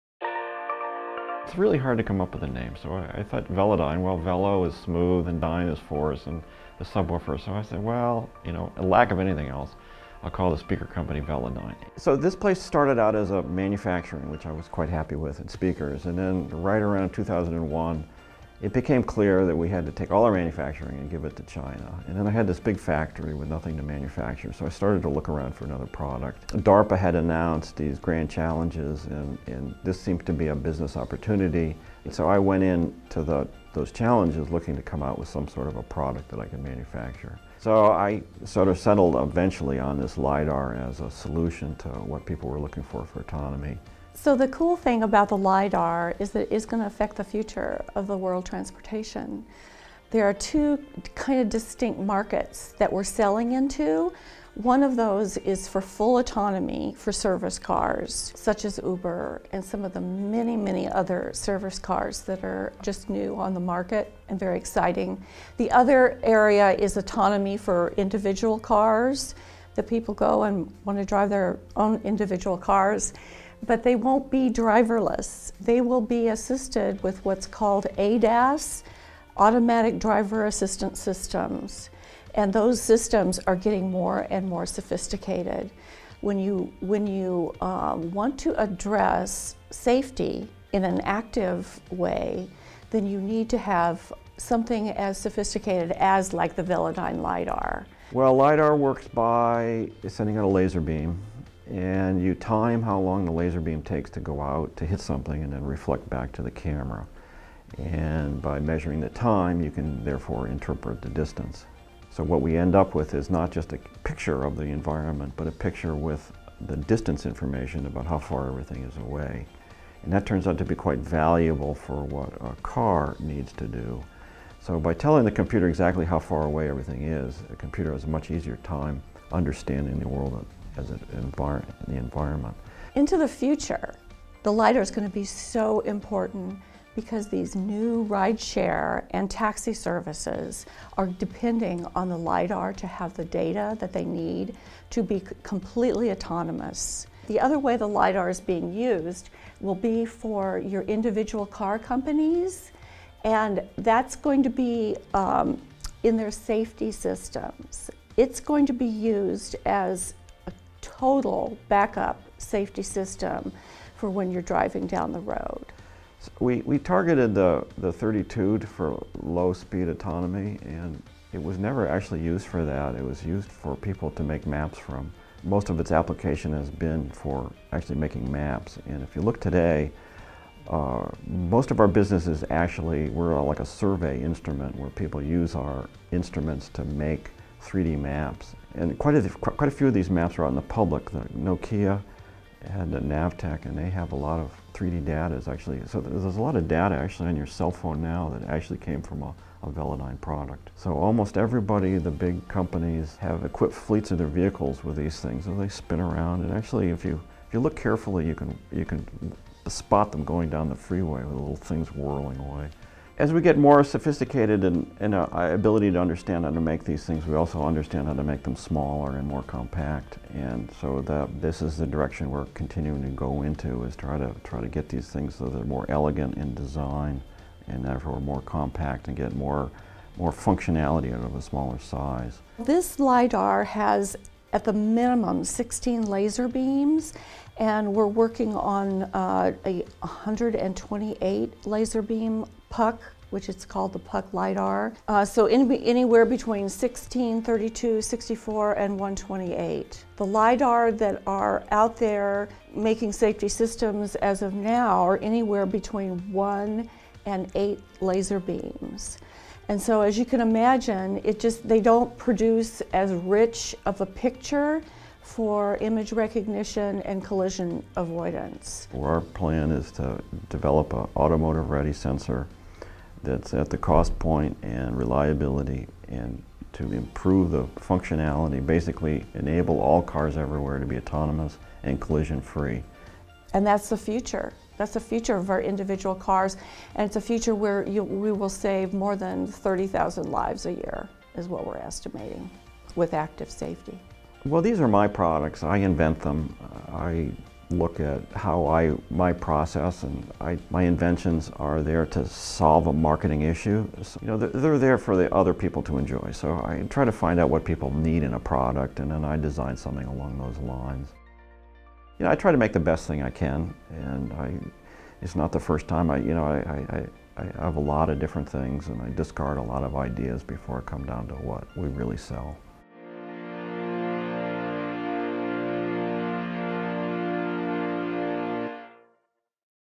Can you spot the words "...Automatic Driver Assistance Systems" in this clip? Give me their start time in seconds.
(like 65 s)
79 s.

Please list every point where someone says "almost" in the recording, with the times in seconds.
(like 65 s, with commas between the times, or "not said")
200 s.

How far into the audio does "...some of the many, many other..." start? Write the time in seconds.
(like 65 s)
59 s.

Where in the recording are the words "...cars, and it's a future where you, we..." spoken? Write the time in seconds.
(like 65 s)
286 s.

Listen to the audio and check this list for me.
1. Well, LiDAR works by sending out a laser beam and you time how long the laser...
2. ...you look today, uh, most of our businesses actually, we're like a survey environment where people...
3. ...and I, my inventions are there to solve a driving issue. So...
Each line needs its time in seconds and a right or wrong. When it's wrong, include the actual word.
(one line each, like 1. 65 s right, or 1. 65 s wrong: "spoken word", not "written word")
1. 98 s right
2. 179 s wrong: "instrument", not "environment"
3. 300 s wrong: "marketing", not "driving".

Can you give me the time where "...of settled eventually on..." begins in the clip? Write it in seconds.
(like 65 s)
38 s.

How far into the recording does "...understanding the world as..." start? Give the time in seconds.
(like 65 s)
129 s.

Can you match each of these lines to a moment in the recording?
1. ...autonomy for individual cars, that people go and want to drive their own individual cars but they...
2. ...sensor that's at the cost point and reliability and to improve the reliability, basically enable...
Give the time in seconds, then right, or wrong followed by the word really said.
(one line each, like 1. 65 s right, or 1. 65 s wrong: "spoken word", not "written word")
1. 66 s right
2. 271 s wrong: "functionality", not "reliability".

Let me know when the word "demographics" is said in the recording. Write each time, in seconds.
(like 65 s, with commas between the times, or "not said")
not said.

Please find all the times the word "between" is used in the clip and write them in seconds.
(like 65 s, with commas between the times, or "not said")
246 s, 255 s.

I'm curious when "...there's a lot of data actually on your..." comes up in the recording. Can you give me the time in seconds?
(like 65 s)
196 s.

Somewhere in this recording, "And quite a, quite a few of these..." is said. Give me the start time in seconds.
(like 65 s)
188 s.